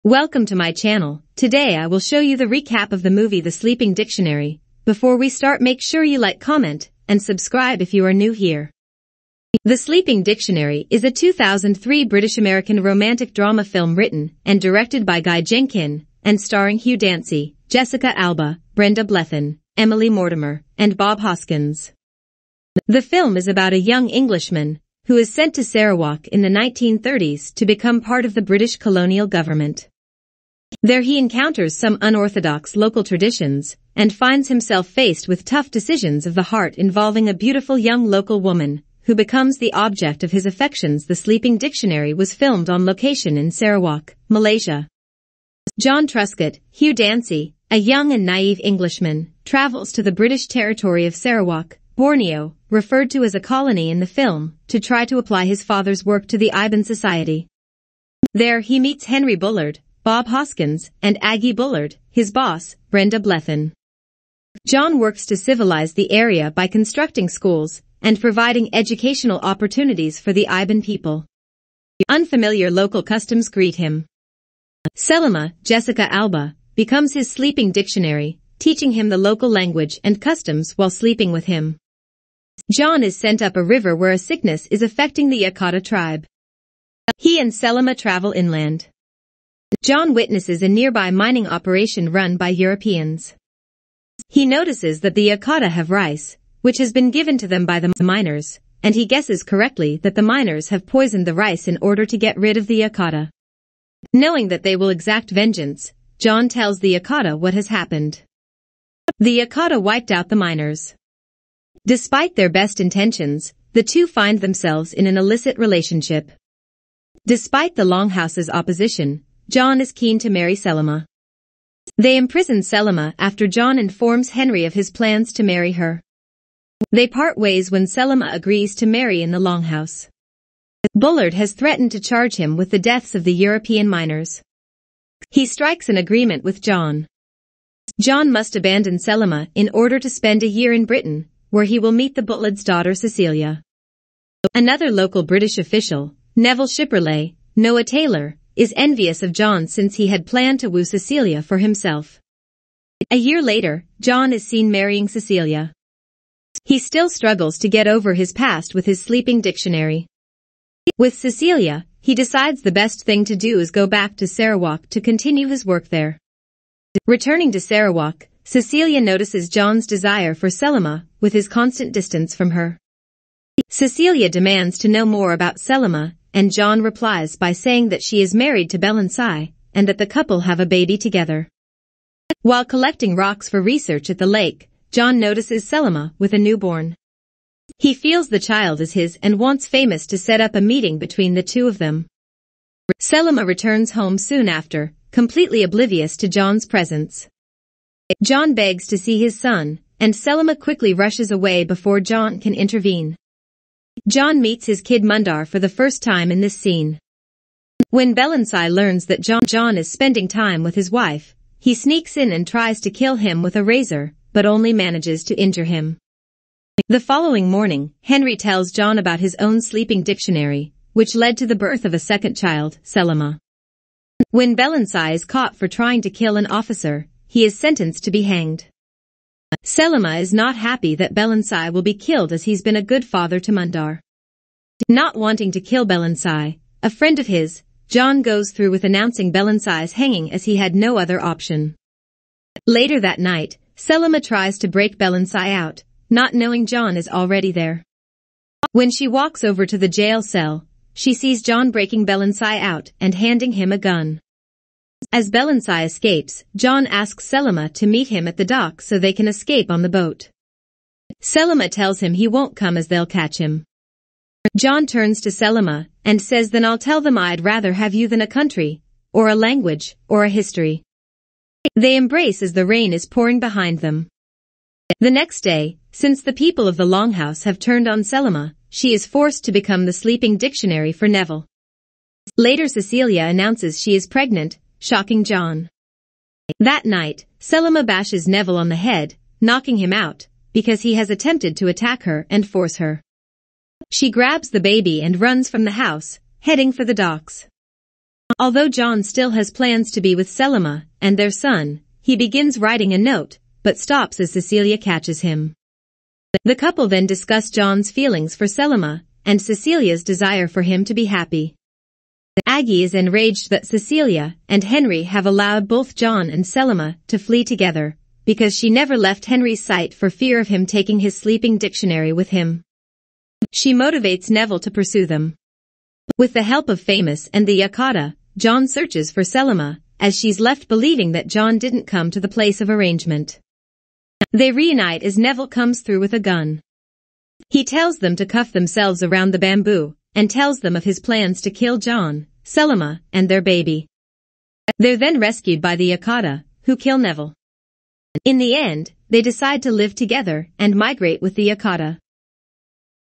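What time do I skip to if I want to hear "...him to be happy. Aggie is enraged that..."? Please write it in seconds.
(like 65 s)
310 s.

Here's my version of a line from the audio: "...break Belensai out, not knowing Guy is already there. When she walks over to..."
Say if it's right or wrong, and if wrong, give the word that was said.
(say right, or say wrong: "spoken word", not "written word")
wrong: "John", not "Guy".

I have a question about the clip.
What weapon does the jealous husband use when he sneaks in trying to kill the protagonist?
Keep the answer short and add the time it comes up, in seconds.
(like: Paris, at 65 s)
A razor, at 213 s.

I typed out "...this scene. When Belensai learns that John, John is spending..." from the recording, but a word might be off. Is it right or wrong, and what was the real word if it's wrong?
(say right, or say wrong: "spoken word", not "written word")
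right.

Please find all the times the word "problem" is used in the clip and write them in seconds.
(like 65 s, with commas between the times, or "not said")
not said.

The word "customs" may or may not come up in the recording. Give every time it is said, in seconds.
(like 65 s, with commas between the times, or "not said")
73 s, 80 s.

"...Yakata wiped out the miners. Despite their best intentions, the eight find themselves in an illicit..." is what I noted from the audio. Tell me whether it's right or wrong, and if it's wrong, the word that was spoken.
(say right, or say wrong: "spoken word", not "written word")
wrong: "two", not "eight".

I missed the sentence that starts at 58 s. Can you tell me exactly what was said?
There he meets Henry Bullard, Bob Hoskins, and Aggie Bullard, his boss, Brenda Blethyn.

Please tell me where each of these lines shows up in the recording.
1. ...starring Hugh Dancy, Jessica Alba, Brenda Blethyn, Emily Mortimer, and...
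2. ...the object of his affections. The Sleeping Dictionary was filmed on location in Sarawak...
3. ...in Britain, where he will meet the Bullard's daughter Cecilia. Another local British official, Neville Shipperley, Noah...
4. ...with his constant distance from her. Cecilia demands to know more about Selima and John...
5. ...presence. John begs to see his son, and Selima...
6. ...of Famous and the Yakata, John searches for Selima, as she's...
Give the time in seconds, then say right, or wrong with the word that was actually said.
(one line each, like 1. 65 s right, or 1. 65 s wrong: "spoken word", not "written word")
1. 16 s right
2. 39 s right
3. 140 s right
4. 171 s right
5. 196 s right
6. 326 s right.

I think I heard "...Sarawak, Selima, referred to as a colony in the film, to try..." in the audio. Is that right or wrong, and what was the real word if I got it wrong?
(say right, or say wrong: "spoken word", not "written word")
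wrong: "Borneo", not "Selima".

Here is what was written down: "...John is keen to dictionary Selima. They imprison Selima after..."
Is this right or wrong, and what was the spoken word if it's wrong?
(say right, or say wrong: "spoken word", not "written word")
wrong: "marry", not "dictionary".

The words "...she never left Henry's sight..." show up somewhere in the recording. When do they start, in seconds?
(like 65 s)
318 s.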